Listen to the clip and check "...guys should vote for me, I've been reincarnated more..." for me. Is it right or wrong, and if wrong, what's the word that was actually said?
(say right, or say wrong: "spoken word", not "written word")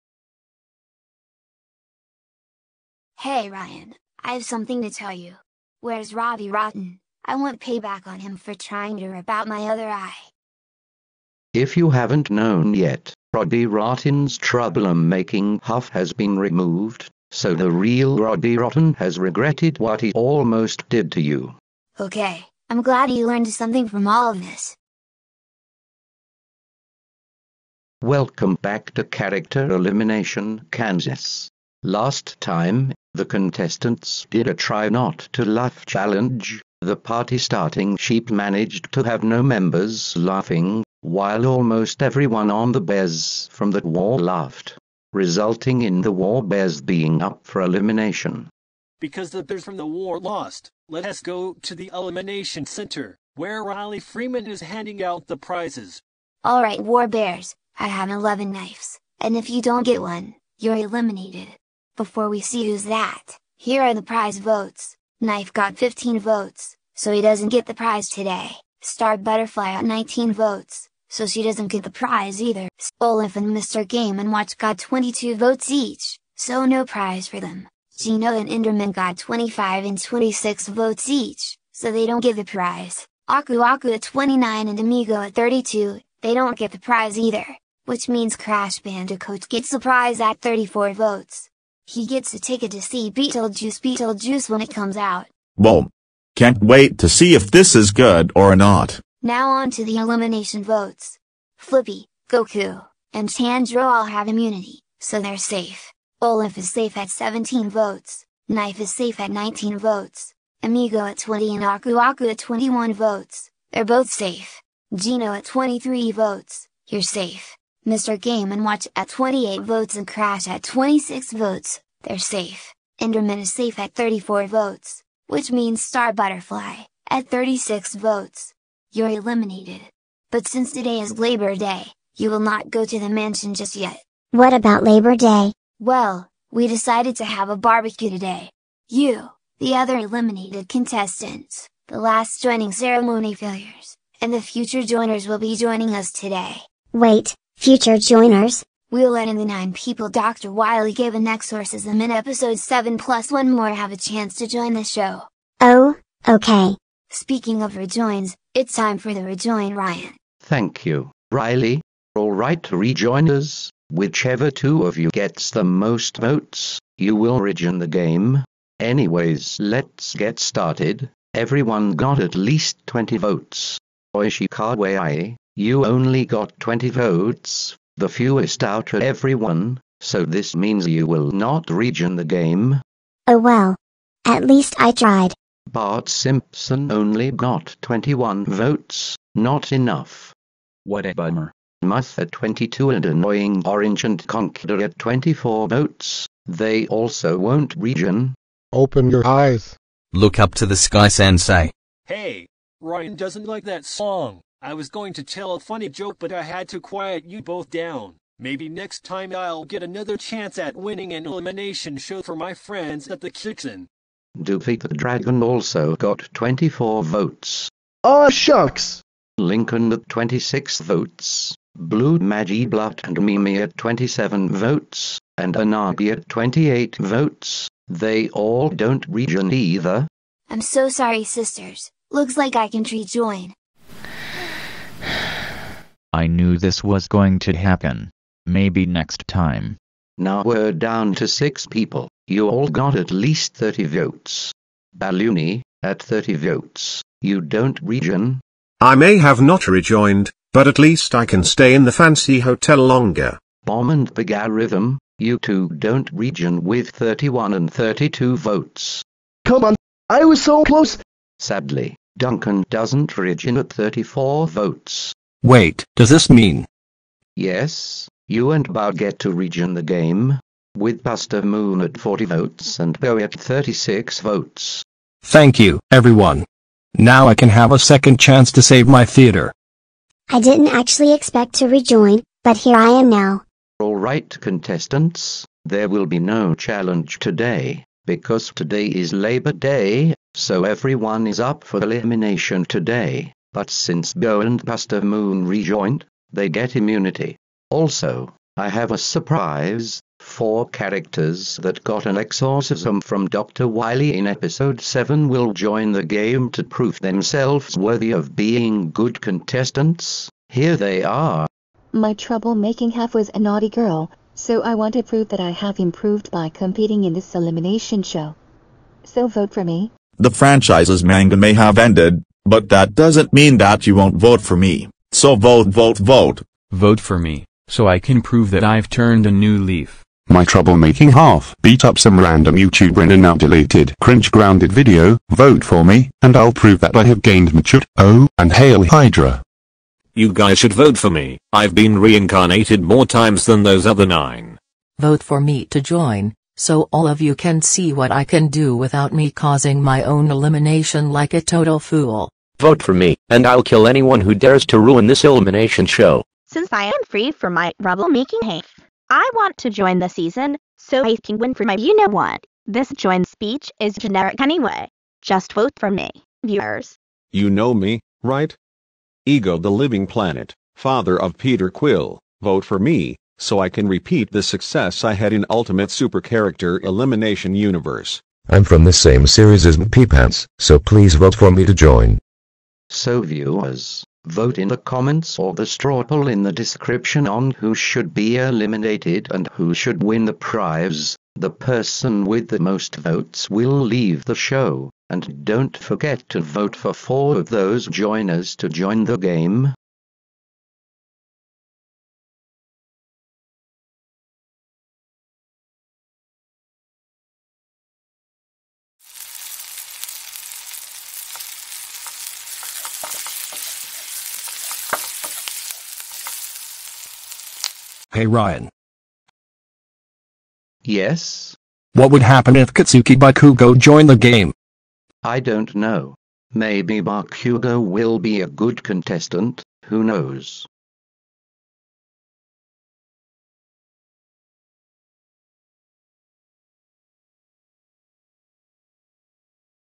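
right.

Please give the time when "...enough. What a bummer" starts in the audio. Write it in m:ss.
3:09.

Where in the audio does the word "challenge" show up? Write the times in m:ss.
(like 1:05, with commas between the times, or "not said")
0:35, 4:46.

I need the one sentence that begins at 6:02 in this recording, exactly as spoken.
This join speech is generic anyway.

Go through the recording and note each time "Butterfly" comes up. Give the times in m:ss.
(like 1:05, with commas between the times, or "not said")
1:09, 2:06.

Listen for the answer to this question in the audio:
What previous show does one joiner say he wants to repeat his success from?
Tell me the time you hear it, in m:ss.
6:15.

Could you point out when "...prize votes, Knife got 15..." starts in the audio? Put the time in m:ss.
1:04.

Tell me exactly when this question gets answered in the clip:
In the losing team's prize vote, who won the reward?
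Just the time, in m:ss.
1:28.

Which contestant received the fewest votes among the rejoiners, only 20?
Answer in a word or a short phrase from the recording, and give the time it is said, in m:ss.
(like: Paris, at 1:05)
Oishikawa, at 2:54.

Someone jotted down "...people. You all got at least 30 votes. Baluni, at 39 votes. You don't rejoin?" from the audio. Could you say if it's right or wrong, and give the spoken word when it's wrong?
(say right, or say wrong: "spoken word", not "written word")
wrong: "30", not "39".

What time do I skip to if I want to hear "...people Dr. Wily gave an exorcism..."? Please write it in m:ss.
2:29.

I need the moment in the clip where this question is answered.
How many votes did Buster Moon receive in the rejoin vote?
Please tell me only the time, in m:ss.
4:31.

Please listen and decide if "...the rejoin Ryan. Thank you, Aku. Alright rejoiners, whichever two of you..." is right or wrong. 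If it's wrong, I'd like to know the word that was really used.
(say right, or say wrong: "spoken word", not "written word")
wrong: "Riley", not "Aku".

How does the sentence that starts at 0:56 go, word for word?
Alright war bears, I have 11 knives, and if you don't get one, you're eliminated.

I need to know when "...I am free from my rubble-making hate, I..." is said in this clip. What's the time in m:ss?
5:56.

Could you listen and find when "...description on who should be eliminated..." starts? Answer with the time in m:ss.
6:26.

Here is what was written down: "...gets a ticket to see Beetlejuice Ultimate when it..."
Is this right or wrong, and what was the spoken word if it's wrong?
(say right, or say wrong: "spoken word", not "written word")
wrong: "Beetlejuice", not "Ultimate".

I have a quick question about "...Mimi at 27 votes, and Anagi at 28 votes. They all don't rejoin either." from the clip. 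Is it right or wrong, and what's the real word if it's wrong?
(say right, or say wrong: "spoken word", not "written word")
right.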